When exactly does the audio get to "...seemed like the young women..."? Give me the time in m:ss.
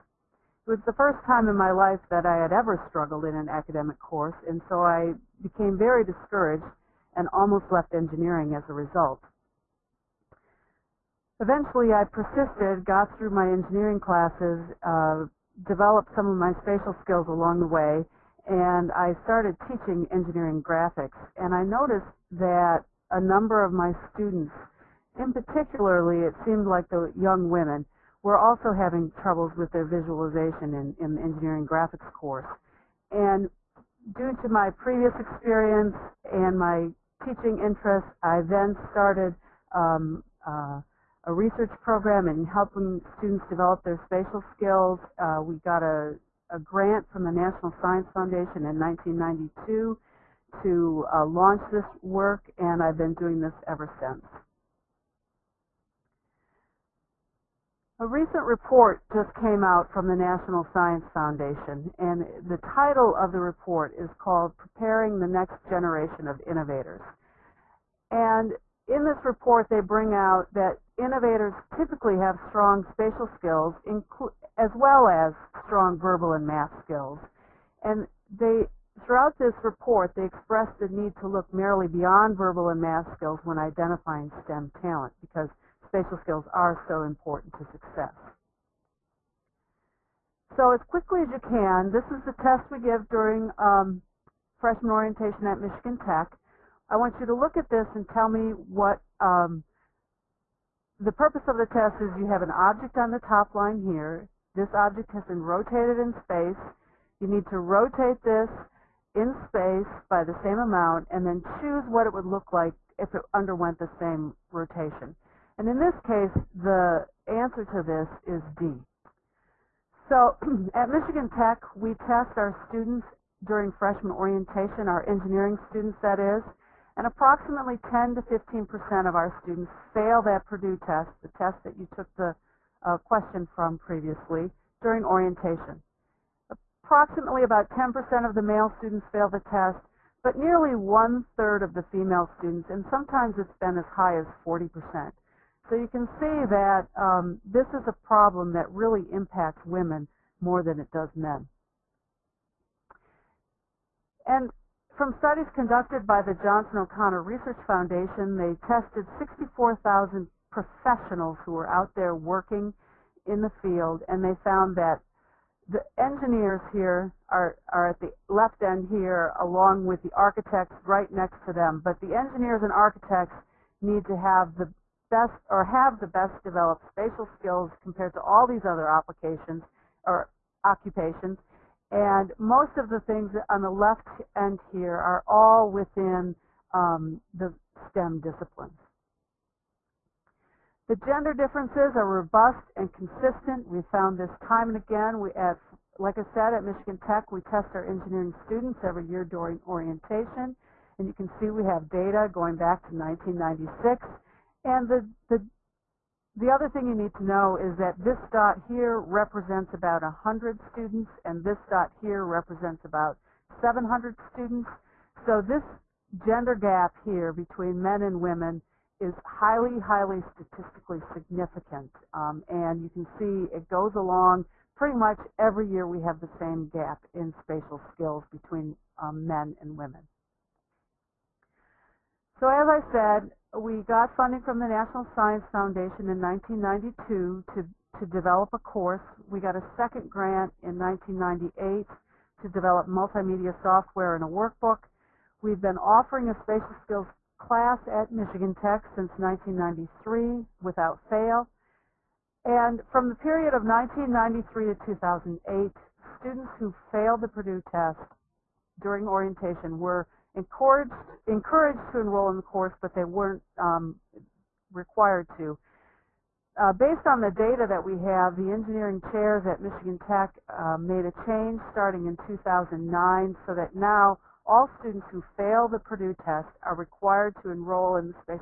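0:26.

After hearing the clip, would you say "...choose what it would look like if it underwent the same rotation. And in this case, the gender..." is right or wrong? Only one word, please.
wrong.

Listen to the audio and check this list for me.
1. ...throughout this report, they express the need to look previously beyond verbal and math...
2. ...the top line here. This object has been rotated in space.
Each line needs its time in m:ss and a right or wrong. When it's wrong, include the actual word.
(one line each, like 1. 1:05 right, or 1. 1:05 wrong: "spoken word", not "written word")
1. 1:18 wrong: "merely", not "previously"
2. 1:43 right.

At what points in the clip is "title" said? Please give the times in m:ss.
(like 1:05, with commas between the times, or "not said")
1:02.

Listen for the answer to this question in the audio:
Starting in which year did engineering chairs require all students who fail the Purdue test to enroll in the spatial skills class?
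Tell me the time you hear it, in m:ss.
4:32.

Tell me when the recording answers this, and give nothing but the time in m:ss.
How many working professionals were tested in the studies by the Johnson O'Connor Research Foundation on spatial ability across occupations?
2:39.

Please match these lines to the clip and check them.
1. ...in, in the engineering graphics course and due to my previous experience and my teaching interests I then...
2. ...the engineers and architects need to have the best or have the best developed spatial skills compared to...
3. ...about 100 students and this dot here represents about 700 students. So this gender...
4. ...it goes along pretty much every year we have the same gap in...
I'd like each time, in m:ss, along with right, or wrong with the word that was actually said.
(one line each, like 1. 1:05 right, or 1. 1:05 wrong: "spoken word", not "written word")
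1. 0:30 right
2. 2:52 right
3. 3:29 right
4. 3:43 right.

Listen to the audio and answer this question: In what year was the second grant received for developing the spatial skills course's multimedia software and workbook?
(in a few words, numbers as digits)
1998.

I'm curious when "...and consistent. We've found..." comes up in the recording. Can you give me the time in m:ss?
3:12.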